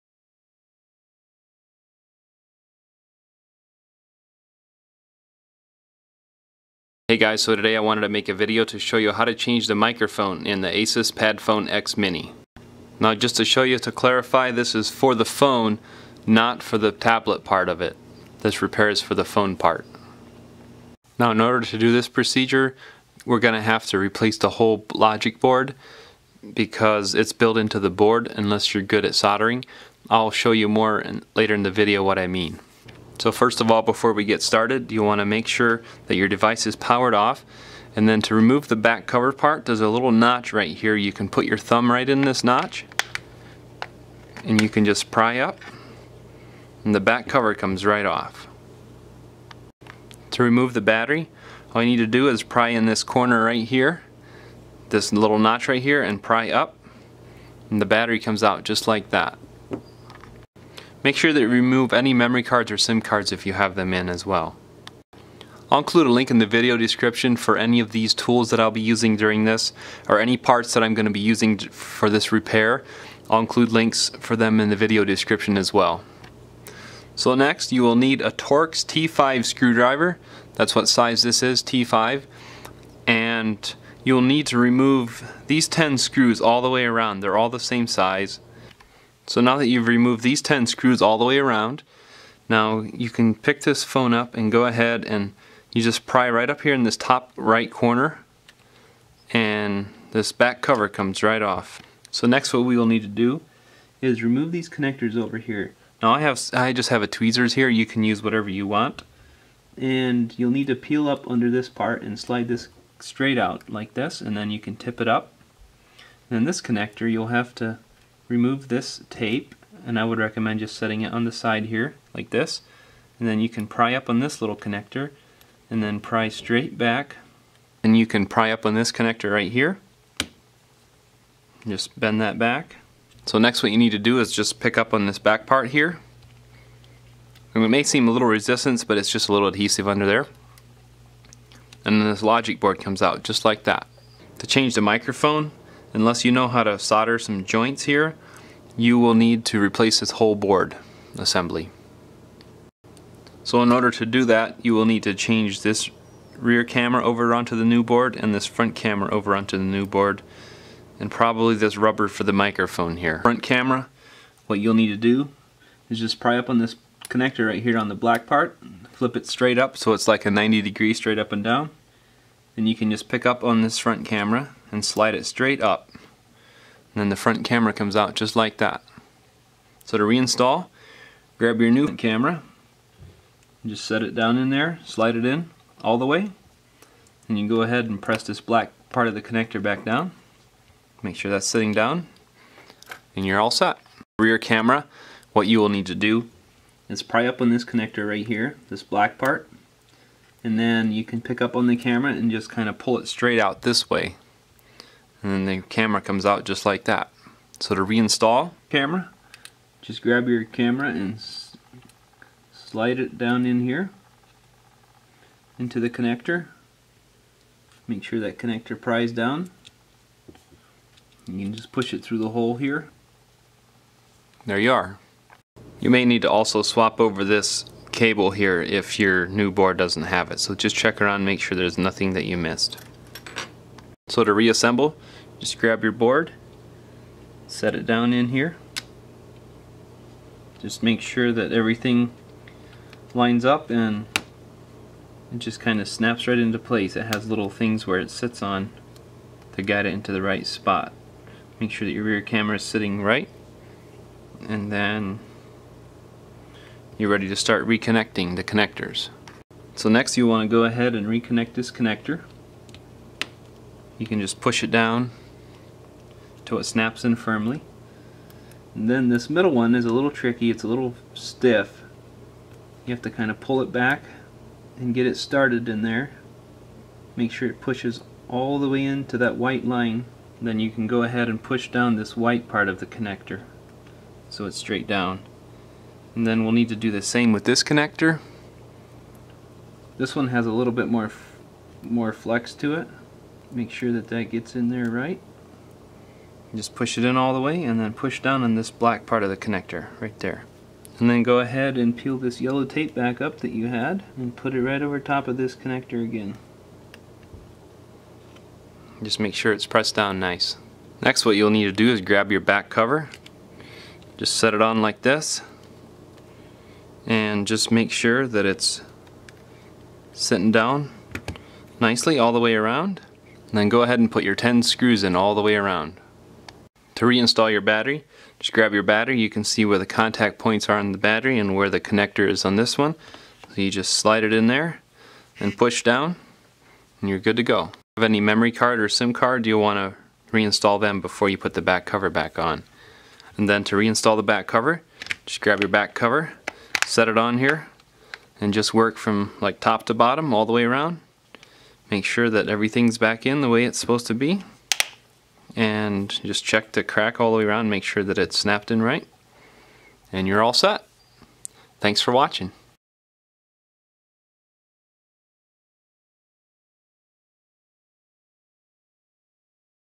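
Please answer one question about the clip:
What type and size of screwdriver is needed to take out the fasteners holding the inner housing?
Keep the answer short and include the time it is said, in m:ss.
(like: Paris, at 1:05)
Torx T5, at 1:18.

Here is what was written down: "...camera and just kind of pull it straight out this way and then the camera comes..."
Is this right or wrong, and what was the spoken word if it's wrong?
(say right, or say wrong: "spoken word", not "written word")
right.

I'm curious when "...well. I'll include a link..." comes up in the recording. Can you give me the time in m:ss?
1:04.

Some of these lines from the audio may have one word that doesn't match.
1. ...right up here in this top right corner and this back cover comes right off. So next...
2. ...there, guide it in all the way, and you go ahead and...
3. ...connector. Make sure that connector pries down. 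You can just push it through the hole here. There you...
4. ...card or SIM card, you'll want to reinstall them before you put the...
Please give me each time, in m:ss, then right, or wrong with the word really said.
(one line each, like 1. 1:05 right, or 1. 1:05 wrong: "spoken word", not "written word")
1. 1:36 right
2. 3:04 wrong: "slide", not "guide"
3. 3:35 right
4. 5:38 right.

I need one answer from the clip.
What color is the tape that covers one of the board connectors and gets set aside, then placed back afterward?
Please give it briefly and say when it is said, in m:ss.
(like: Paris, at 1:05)
yellow, at 5:02.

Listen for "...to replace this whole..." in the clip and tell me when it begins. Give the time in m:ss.
2:29.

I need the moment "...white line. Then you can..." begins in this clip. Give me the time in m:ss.
4:39.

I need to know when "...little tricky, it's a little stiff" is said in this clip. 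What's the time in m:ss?
4:29.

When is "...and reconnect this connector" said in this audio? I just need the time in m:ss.
4:20.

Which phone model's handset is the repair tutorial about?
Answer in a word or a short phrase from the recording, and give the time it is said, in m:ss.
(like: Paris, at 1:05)
Asus PadFone X Mini, at 0:10.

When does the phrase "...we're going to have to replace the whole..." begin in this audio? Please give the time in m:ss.
0:23.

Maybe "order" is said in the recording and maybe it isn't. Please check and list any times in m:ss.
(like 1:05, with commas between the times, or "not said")
0:21, 2:33.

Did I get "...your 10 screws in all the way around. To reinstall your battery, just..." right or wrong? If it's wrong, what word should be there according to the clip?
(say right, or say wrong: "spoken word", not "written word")
right.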